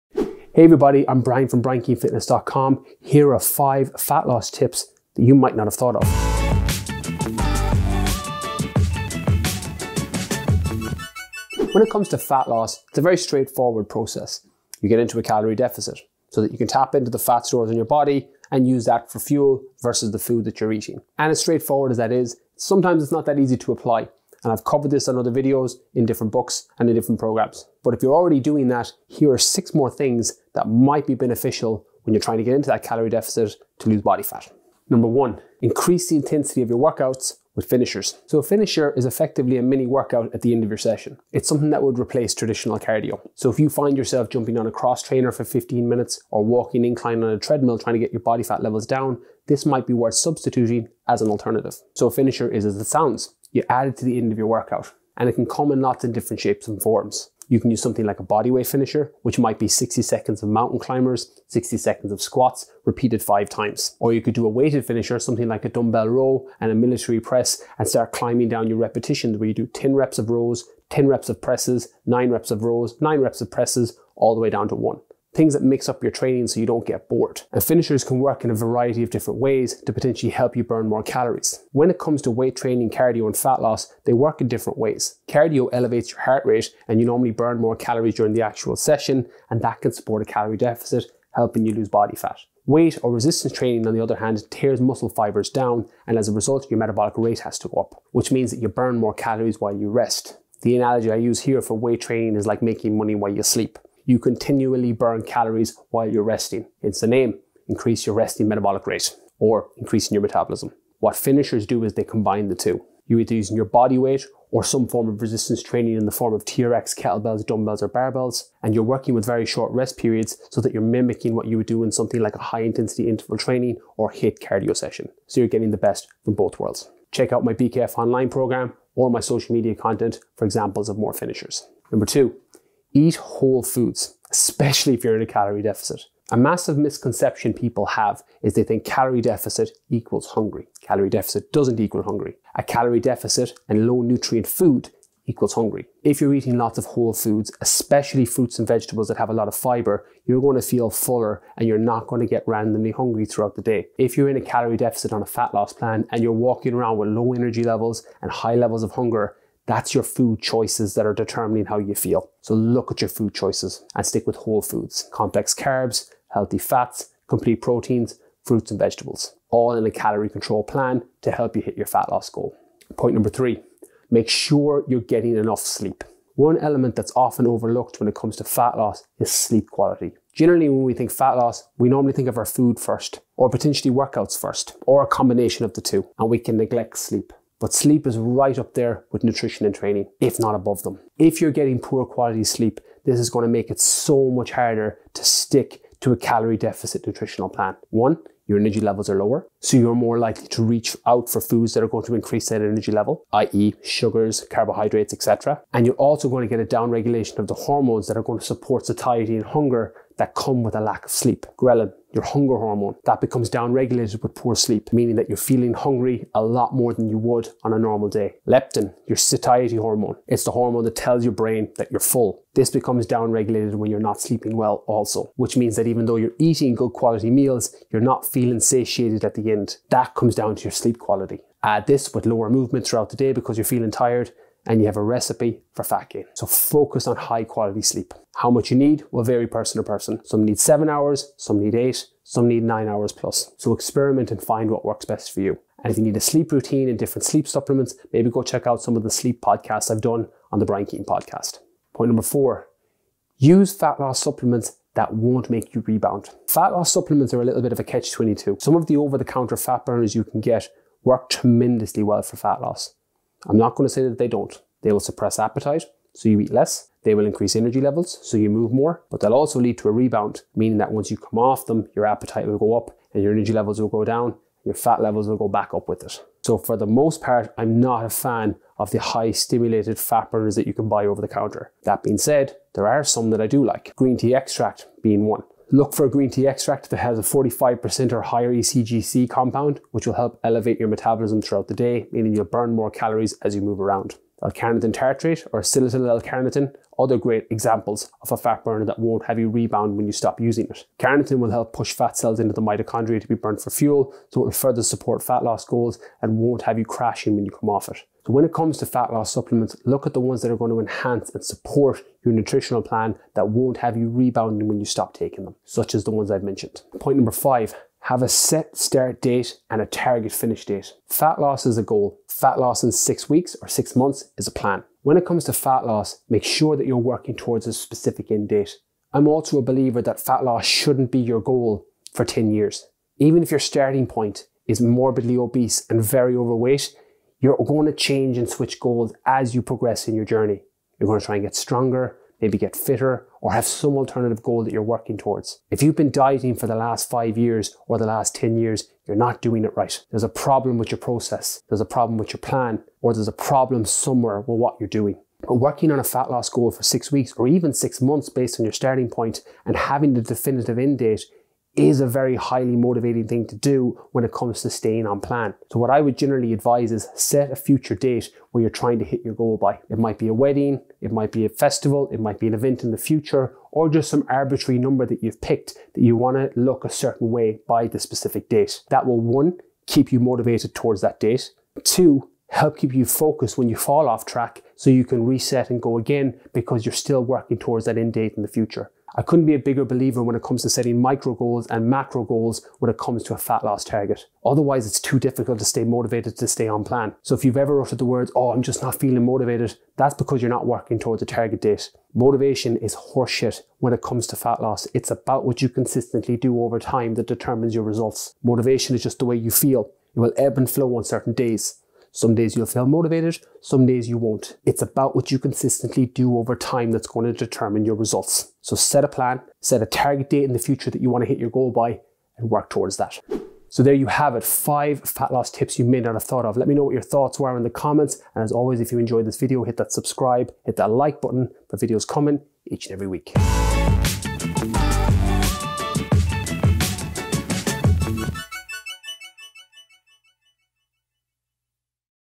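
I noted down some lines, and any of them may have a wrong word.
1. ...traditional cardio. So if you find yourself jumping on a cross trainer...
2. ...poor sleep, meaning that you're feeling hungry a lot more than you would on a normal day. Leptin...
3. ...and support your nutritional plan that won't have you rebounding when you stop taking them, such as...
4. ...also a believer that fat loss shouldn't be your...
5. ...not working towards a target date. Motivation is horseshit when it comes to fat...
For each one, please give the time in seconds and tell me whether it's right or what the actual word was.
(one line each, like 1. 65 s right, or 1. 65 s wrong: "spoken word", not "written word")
1. 42 s right
2. 214 s right
3. 311 s right
4. 329 s right
5. 400 s right.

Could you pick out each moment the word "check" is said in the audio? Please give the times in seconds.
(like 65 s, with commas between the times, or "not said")
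127 s, 248 s.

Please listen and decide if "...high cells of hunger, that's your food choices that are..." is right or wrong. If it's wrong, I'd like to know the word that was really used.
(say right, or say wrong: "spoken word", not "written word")
wrong: "levels", not "cells".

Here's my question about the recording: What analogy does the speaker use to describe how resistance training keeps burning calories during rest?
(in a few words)
Making money while you sleep.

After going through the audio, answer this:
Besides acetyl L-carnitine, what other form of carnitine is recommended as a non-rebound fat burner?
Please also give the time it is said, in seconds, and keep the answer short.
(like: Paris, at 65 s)
L-carnitine tartrate, at 294 s.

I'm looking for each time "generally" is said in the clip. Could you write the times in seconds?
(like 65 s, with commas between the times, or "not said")
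180 s, 366 s.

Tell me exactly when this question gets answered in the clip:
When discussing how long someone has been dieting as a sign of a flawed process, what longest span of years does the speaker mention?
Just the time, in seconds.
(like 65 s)
347 s.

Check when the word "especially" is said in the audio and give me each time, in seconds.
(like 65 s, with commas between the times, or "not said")
134 s, 147 s.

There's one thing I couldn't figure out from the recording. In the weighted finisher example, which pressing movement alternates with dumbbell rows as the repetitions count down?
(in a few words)
Military press.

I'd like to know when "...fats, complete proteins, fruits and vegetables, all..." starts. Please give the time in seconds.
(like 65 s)
166 s.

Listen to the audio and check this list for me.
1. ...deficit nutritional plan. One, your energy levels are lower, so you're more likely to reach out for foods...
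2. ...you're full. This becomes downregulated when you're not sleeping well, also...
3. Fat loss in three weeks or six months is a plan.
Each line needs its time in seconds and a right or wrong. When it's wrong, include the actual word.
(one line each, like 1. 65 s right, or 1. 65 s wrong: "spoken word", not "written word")
1. 196 s right
2. 221 s right
3. 322 s wrong: "six", not "three".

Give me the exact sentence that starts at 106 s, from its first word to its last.
It's the name, increase your resting metabolic rate or increasing your metabolism.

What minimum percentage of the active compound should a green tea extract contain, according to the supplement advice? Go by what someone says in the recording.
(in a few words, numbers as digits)
45%.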